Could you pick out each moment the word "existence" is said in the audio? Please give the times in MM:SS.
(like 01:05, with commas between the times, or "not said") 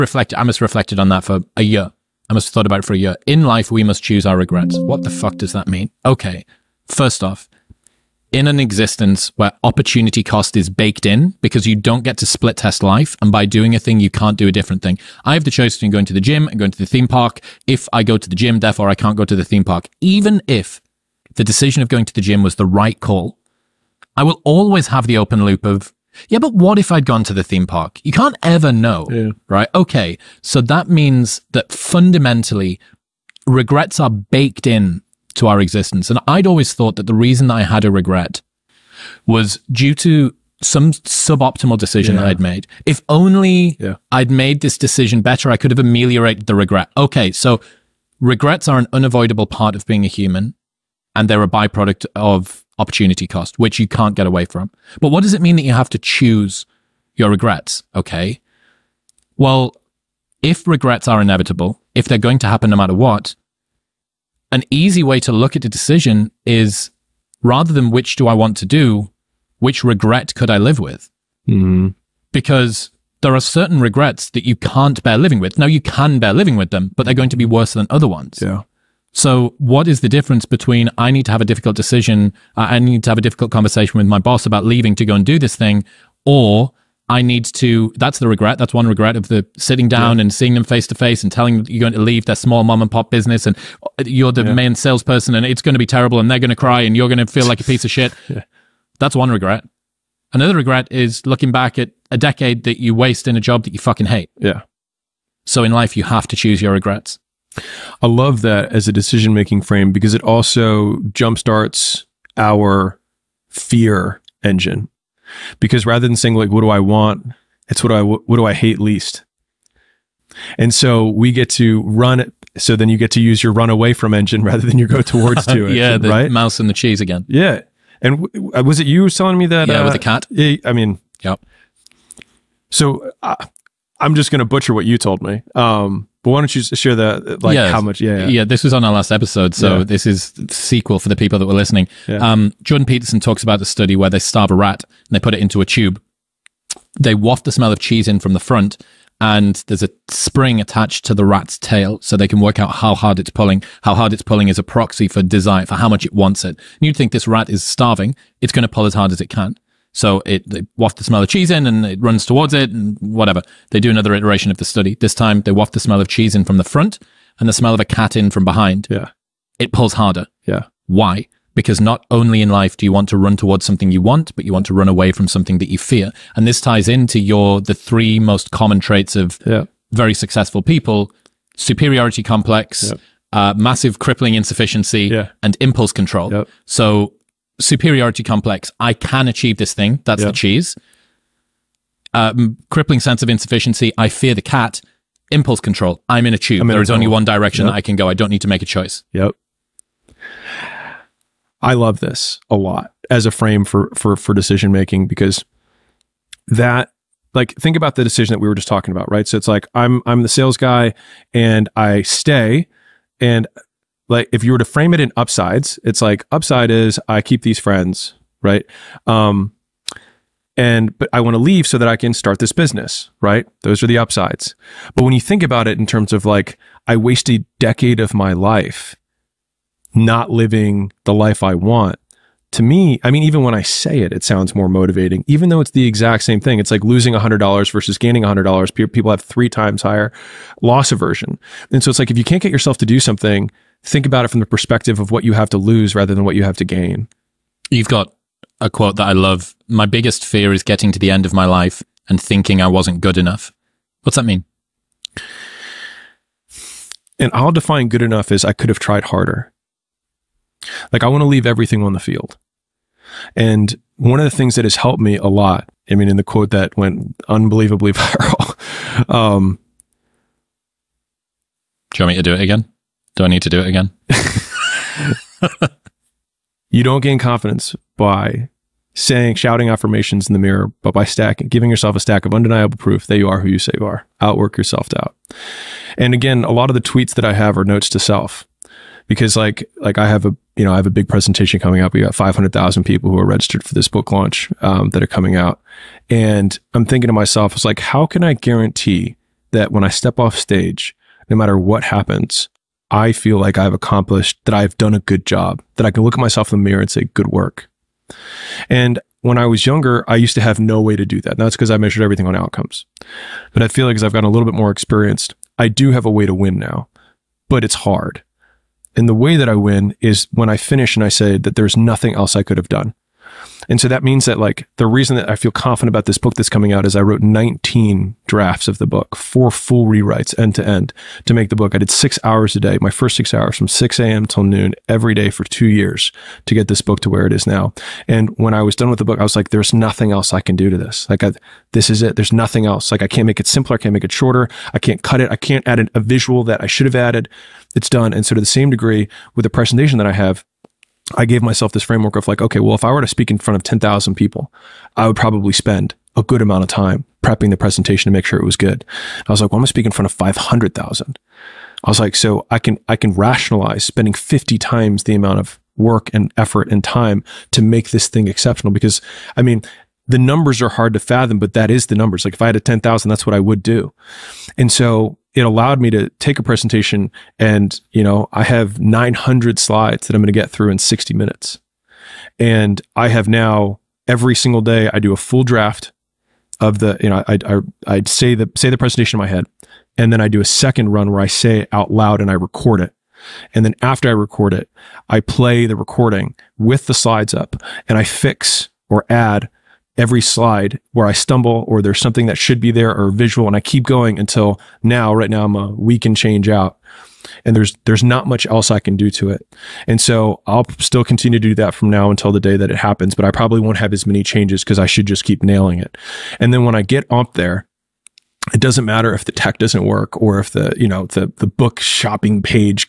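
00:08, 00:35.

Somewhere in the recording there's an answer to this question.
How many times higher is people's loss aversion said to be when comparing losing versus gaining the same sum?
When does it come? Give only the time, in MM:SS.
03:59.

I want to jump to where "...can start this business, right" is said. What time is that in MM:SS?
03:41.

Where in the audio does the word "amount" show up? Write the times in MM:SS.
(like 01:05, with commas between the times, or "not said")
05:56, 06:05.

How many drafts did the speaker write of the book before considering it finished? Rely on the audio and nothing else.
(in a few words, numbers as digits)
19.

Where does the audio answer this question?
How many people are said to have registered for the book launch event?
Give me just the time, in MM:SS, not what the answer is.
04:52.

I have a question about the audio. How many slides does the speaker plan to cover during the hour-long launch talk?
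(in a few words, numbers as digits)
900.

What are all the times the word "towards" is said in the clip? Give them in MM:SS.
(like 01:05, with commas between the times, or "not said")
02:05, 02:42, 02:53.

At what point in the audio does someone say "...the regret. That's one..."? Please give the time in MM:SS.
01:28.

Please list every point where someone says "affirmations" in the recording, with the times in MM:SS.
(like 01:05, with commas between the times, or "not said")
04:39.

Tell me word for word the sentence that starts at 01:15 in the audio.
Now, you can bear living with them, but they're going to be worse than other ones.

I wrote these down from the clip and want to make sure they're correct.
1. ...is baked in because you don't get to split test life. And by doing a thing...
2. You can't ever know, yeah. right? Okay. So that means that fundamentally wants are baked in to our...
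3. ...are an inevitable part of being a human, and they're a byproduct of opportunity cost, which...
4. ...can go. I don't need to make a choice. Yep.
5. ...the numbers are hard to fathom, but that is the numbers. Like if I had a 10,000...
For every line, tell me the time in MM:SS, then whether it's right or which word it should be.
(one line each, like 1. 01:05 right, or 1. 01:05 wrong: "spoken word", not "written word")
1. 00:10 right
2. 00:28 wrong: "regrets", not "wants"
3. 00:48 wrong: "unavoidable", not "inevitable"
4. 03:17 right
5. 06:10 right.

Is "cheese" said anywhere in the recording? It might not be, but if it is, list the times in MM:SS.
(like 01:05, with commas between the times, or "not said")
02:06, 02:27, 02:41, 02:46, 03:10.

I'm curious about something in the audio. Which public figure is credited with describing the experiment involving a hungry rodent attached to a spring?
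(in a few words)
Jordan Peterson.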